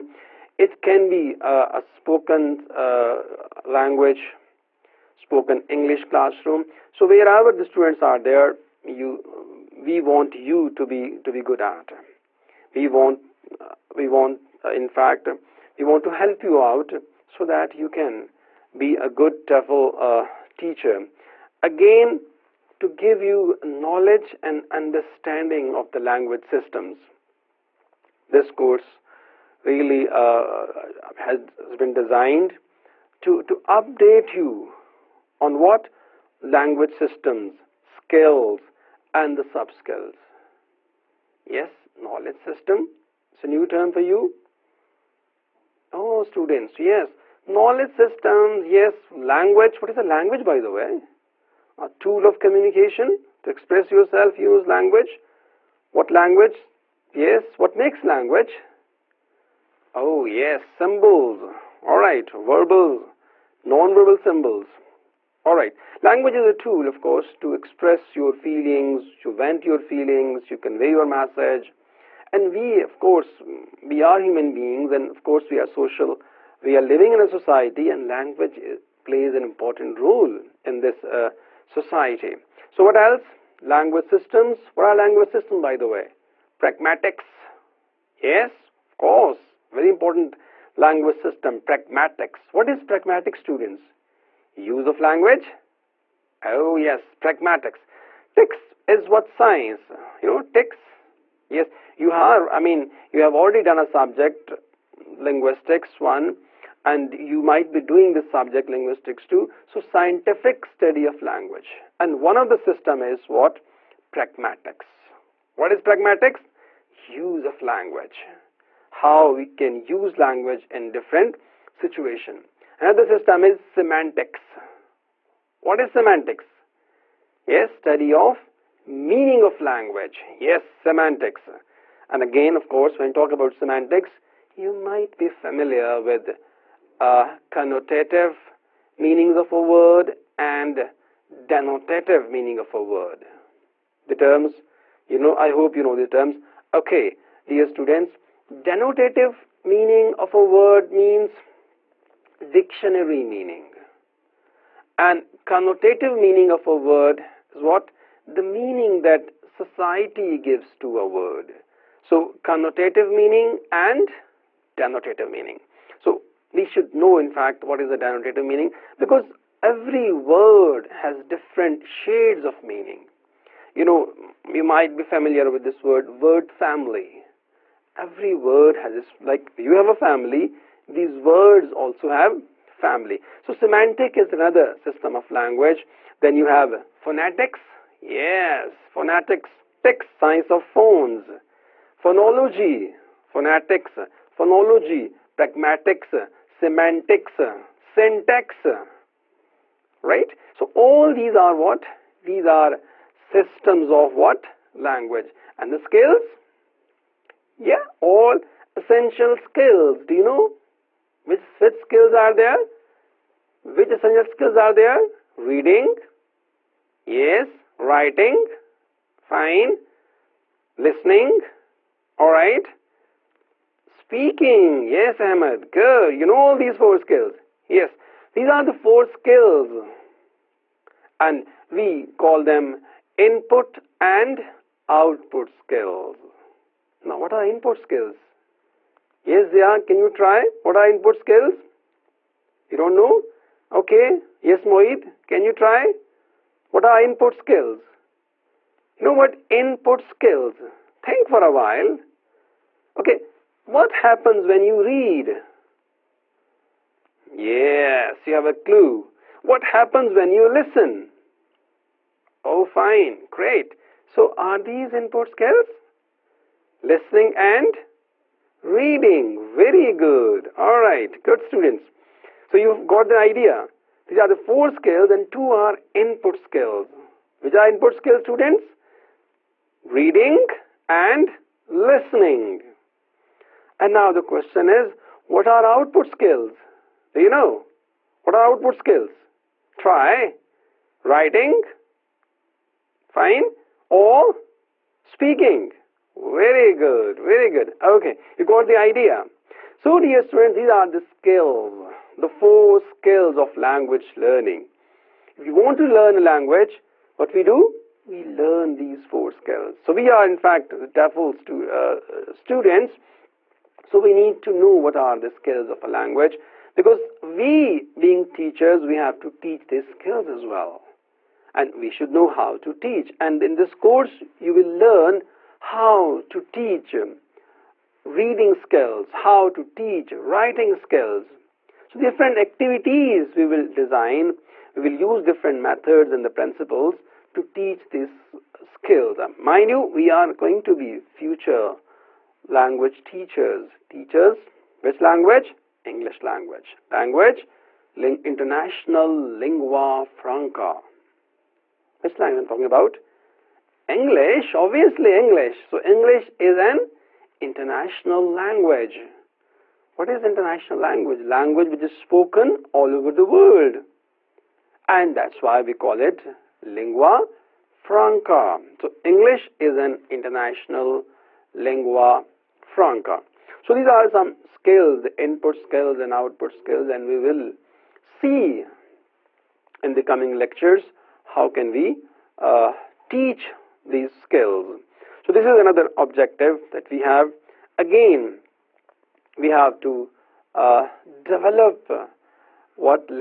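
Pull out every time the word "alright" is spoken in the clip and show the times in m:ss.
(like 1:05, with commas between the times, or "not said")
3:42.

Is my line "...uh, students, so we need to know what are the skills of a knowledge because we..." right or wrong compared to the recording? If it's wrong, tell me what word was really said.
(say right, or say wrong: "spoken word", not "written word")
wrong: "language", not "knowledge".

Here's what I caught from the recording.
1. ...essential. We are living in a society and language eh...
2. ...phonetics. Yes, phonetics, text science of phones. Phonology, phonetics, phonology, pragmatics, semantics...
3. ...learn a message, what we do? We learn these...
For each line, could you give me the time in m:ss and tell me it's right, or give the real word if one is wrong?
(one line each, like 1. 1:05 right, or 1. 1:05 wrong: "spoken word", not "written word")
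1. 1:15 wrong: "social", not "essential"
2. 3:06 right
3. 5:05 wrong: "language", not "message".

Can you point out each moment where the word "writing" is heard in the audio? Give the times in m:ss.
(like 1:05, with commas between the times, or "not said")
3:37, 4:51, 5:30.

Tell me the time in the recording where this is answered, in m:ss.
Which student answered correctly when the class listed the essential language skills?
3:45.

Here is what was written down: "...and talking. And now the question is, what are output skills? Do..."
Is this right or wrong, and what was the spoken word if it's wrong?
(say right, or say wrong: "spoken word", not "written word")
wrong: "listening", not "talking".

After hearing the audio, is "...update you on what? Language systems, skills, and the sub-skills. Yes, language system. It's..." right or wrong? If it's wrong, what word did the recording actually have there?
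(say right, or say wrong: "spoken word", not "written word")
wrong: "knowledge", not "language".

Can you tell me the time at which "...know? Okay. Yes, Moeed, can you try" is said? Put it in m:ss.
4:02.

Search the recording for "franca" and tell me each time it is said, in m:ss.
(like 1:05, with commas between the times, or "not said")
5:50, 6:07, 6:12.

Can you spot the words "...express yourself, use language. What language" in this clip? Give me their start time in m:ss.
0:53.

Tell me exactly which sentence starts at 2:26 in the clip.
Okay, dear students, denotative meaning of a word means dictionary meaning.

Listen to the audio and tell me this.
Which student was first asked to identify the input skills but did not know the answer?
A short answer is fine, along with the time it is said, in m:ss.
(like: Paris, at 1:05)
Zia, at 3:59.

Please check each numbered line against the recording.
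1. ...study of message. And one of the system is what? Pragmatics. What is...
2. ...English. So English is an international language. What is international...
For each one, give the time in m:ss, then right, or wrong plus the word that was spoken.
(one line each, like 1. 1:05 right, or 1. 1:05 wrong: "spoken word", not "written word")
1. 1:50 wrong: "language", not "message"
2. 5:55 right.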